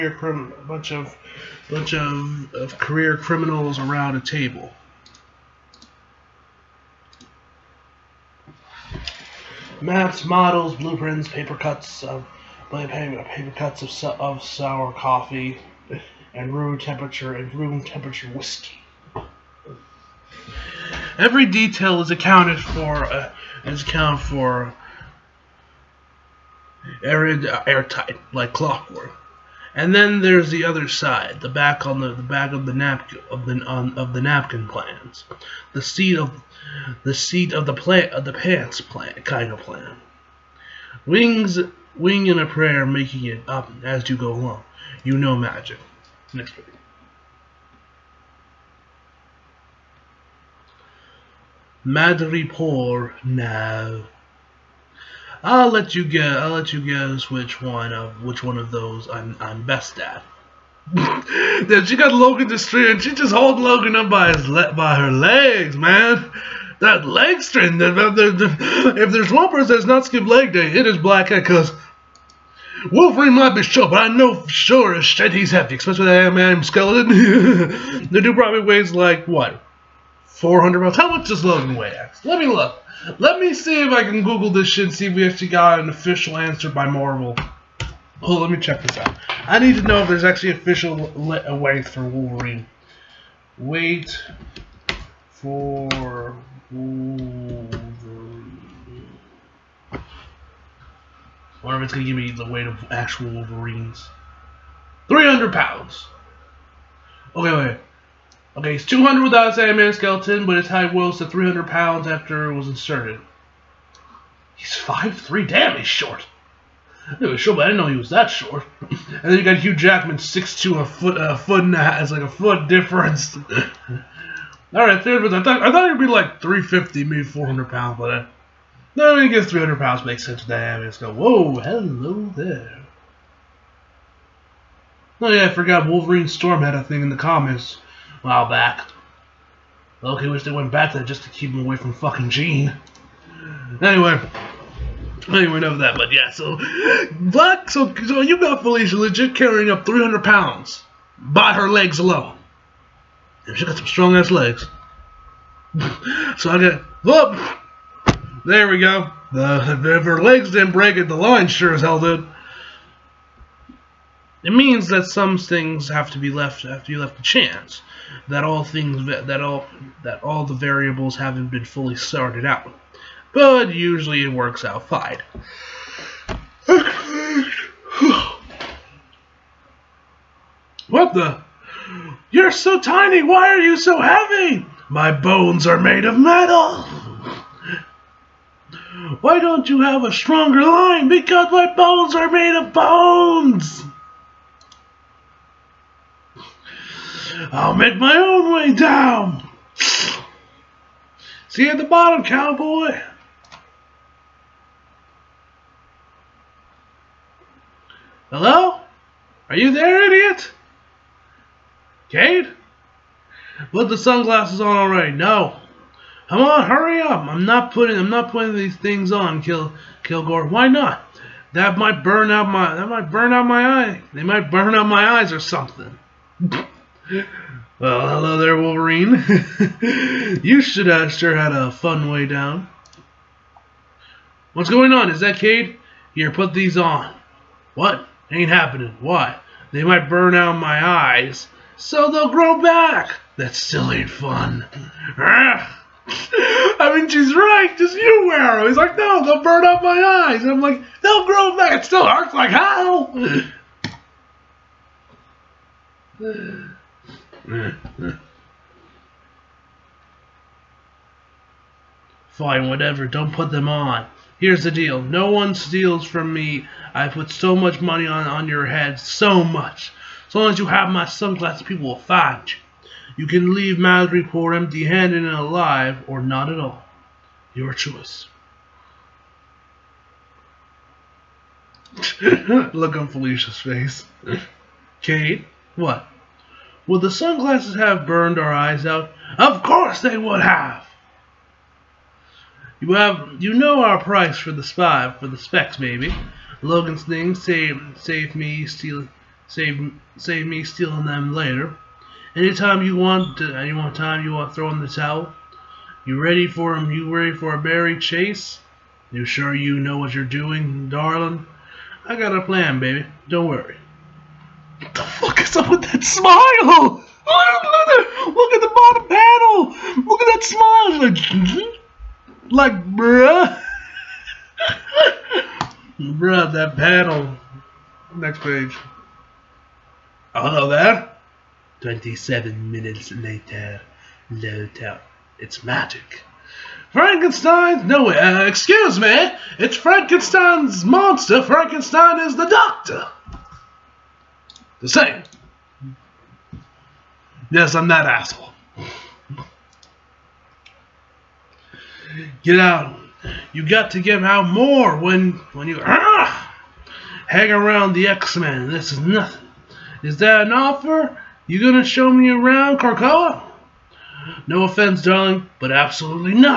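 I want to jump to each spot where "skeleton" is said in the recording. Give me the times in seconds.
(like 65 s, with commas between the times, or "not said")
76 s, 109 s.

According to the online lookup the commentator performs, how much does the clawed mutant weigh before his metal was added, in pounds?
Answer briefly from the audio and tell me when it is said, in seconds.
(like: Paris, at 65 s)
200, at 108 s.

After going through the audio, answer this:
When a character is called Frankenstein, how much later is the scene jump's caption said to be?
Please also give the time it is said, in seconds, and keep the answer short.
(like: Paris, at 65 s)
27 minutes, at 331 s.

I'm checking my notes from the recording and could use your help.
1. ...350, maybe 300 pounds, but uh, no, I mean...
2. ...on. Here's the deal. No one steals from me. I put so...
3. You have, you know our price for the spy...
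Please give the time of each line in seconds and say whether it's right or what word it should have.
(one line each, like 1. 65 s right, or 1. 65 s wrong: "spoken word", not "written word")
1. 126 s wrong: "400", not "300"
2. 263 s right
3. 292 s right.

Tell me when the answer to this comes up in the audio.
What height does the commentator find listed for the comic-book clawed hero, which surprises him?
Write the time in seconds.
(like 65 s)
114 s.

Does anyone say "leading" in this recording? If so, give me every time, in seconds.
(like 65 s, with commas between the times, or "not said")
not said.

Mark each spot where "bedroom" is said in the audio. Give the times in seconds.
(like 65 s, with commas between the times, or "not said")
not said.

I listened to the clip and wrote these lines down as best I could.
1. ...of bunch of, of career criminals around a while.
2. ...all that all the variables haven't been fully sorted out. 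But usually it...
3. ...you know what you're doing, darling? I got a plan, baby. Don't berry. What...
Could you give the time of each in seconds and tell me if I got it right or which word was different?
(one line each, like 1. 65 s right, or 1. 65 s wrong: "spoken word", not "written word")
1. 0 s wrong: "table", not "while"
2. 169 s right
3. 309 s wrong: "worry", not "berry".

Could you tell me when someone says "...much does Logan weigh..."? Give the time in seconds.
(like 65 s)
81 s.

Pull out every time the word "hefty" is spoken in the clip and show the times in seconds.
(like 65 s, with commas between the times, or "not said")
75 s.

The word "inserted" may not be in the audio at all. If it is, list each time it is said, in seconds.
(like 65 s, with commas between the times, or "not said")
112 s.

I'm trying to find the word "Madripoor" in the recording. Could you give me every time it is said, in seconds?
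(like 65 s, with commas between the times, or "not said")
51 s, 273 s.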